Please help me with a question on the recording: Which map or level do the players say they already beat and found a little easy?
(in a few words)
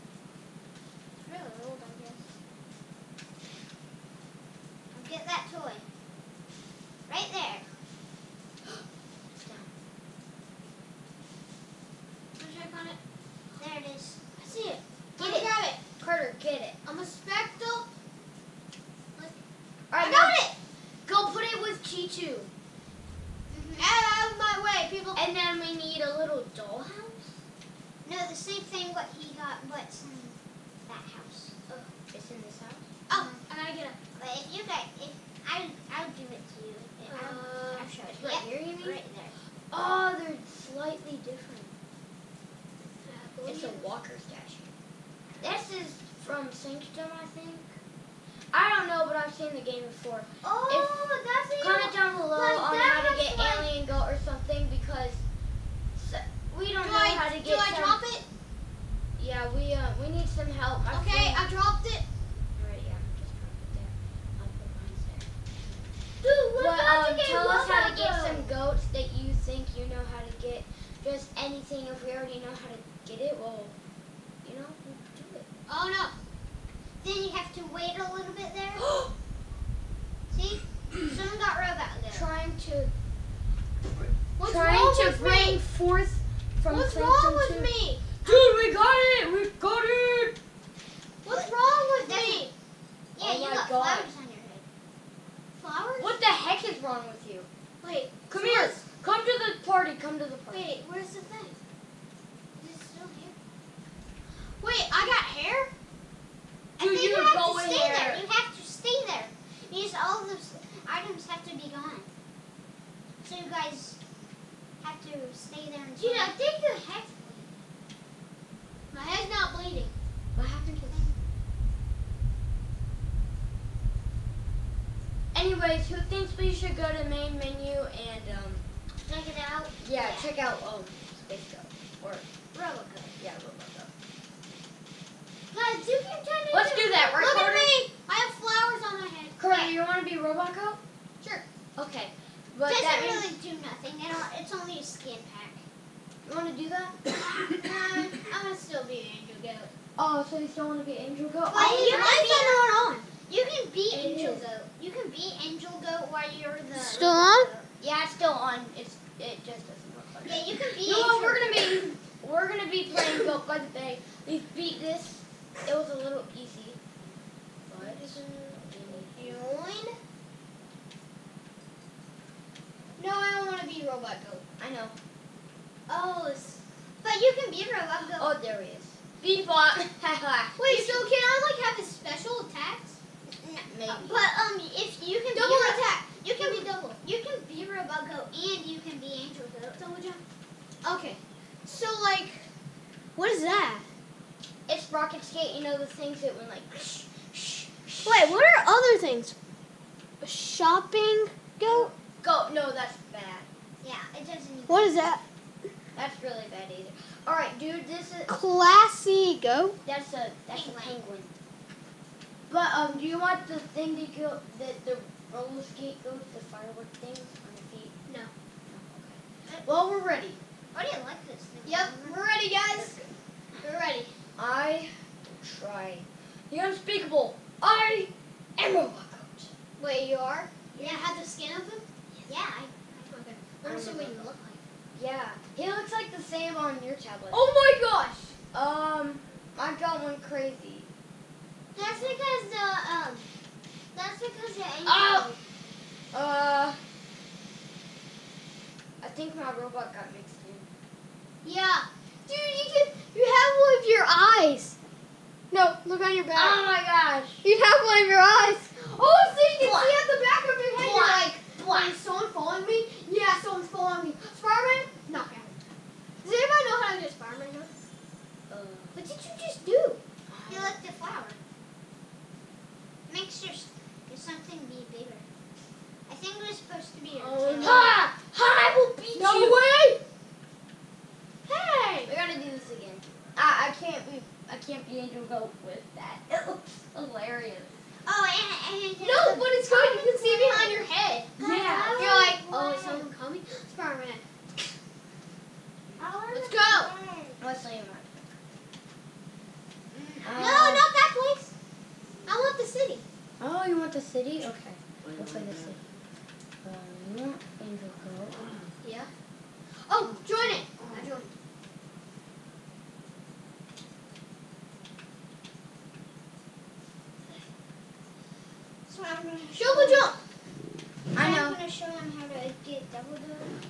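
Goat by the Bay.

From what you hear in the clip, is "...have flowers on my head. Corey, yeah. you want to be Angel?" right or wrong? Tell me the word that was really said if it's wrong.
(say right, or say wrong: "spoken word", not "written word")
wrong: "Roboco", not "Angel".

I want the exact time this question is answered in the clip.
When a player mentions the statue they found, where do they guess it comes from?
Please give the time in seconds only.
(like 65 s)
46 s.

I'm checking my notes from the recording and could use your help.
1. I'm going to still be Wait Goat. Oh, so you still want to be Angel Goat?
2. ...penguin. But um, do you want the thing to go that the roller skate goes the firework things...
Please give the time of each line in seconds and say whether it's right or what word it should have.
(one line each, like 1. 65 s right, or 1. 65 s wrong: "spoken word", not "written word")
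1. 147 s wrong: "Angel", not "Wait"
2. 210 s right.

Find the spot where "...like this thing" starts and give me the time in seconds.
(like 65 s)
221 s.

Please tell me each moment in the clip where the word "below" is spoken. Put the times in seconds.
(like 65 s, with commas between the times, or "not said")
52 s.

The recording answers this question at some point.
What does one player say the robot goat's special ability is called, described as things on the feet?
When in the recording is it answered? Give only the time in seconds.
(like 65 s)
194 s.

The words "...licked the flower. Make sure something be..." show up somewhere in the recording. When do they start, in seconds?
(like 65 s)
270 s.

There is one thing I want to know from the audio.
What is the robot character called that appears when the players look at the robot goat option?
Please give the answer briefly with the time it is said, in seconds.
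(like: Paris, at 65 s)
Beatbot, at 179 s.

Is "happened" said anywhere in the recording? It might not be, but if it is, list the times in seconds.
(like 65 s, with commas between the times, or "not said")
120 s.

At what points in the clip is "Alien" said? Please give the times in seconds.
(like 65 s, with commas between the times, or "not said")
53 s.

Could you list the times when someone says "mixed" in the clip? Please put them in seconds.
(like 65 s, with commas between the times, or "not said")
250 s.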